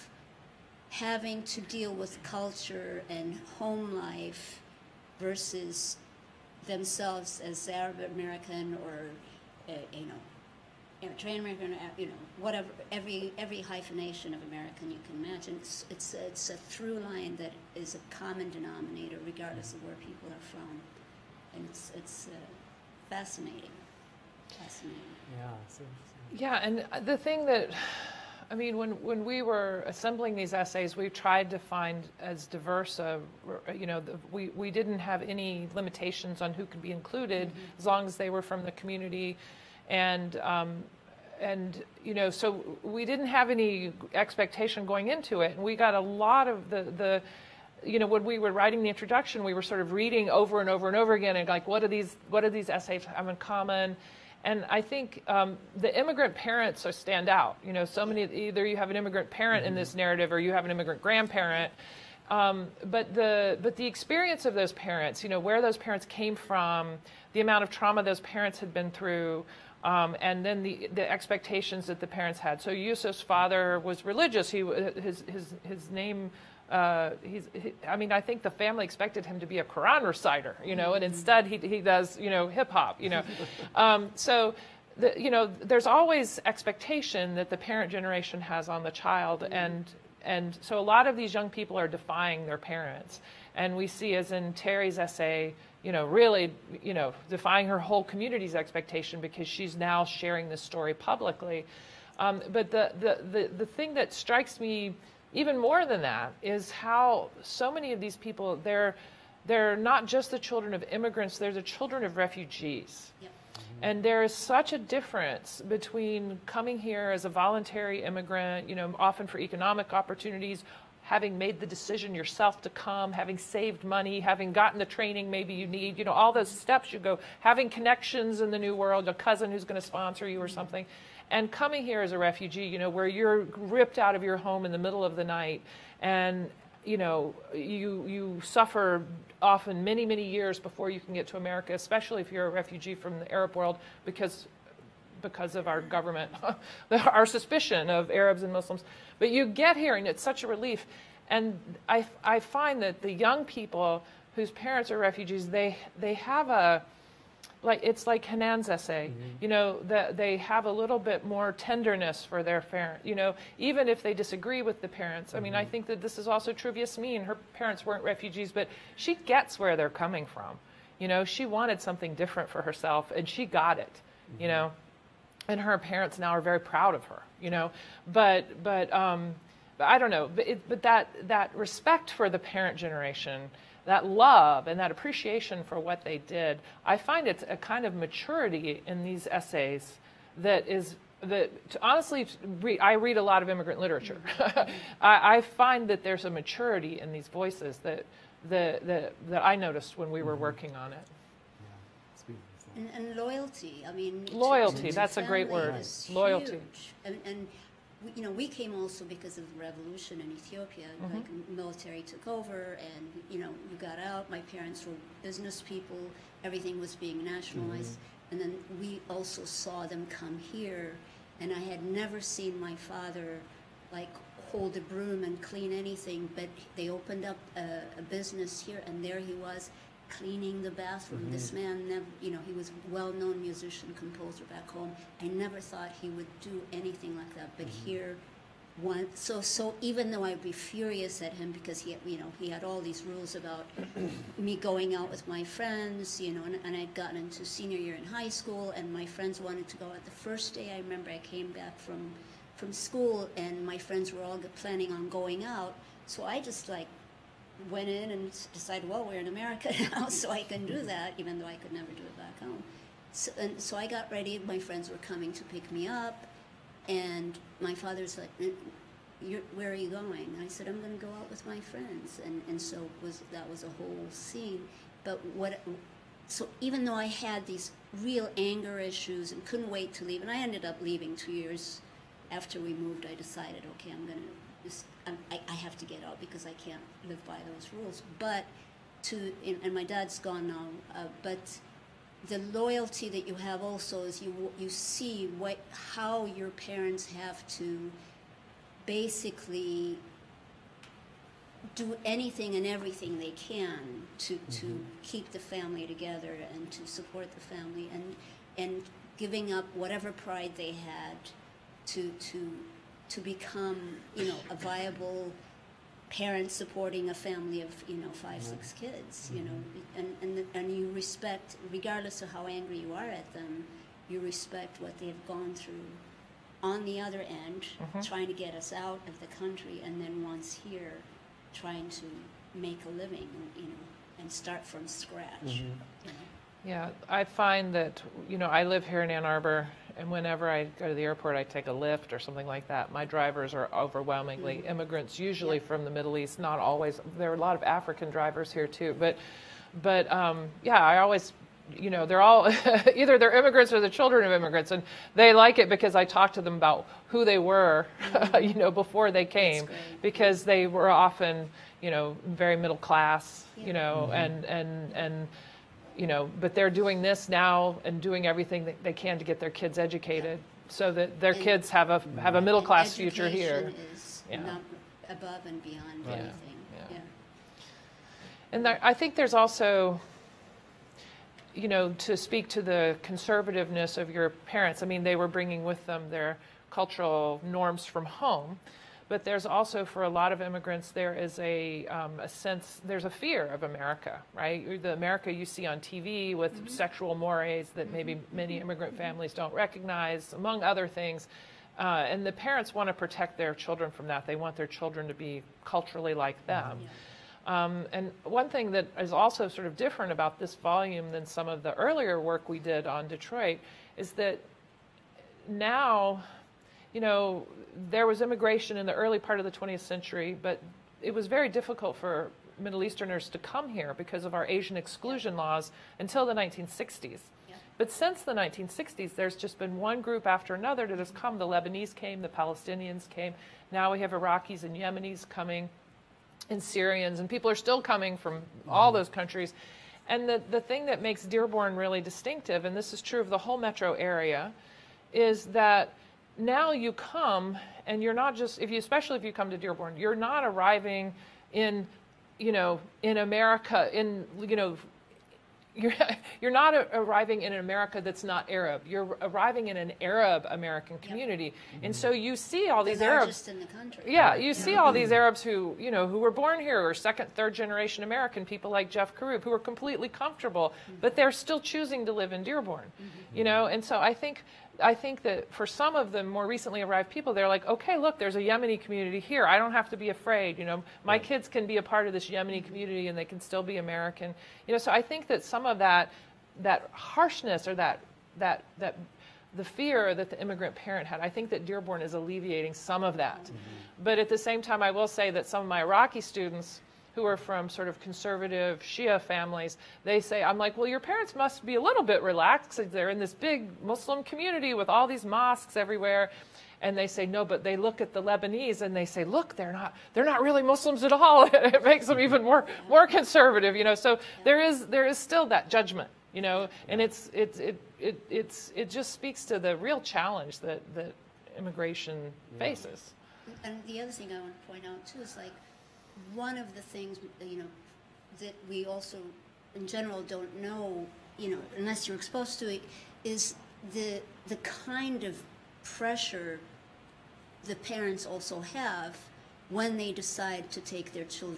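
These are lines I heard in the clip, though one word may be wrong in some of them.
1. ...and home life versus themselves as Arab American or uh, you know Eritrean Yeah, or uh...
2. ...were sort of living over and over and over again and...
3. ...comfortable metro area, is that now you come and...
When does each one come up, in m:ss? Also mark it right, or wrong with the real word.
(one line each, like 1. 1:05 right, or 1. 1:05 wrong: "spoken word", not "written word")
1. 0:03 wrong: "American", not "Yeah"
2. 0:49 wrong: "reading", not "living"
3. 7:23 wrong: "whole", not "comfortable".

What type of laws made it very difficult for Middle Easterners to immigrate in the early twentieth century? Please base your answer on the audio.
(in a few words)
Asian exclusion laws.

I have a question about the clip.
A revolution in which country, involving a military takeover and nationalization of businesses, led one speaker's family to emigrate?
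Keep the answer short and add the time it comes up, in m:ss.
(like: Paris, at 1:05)
Ethiopia, at 3:30.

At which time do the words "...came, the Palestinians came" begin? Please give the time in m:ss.
7:11.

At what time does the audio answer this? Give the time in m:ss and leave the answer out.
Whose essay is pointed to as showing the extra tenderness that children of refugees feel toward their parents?
2:38.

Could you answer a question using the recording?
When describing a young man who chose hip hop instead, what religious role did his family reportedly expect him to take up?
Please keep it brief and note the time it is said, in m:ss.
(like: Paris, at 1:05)
Quran reciter, at 1:19.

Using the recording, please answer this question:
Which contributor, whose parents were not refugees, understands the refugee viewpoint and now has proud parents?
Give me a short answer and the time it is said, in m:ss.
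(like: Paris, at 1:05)
Yasmin, at 2:46.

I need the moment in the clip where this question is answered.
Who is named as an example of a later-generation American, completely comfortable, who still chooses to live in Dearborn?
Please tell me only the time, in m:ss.
7:48.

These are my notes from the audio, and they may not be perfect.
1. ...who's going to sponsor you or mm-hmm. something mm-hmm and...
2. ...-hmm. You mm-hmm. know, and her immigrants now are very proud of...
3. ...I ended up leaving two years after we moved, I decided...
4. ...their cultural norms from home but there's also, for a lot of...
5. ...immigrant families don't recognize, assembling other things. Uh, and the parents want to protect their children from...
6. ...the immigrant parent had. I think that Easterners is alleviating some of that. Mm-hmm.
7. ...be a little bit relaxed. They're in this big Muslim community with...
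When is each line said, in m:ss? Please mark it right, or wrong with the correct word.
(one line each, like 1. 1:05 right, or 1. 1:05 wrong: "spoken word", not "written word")
1. 2:09 right
2. 2:53 wrong: "parents", not "immigrants"
3. 4:40 right
4. 6:26 right
5. 6:38 wrong: "among", not "assembling"
6. 8:10 wrong: "Dearborn", not "Easterners"
7. 8:21 right.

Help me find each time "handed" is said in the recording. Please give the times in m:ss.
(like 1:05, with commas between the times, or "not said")
not said.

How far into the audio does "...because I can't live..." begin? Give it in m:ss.
4:46.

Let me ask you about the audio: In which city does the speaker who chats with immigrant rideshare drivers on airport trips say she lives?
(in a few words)
Ann Arbor.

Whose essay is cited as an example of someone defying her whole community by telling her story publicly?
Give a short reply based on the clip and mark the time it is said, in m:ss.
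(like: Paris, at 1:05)
Terry, at 1:34.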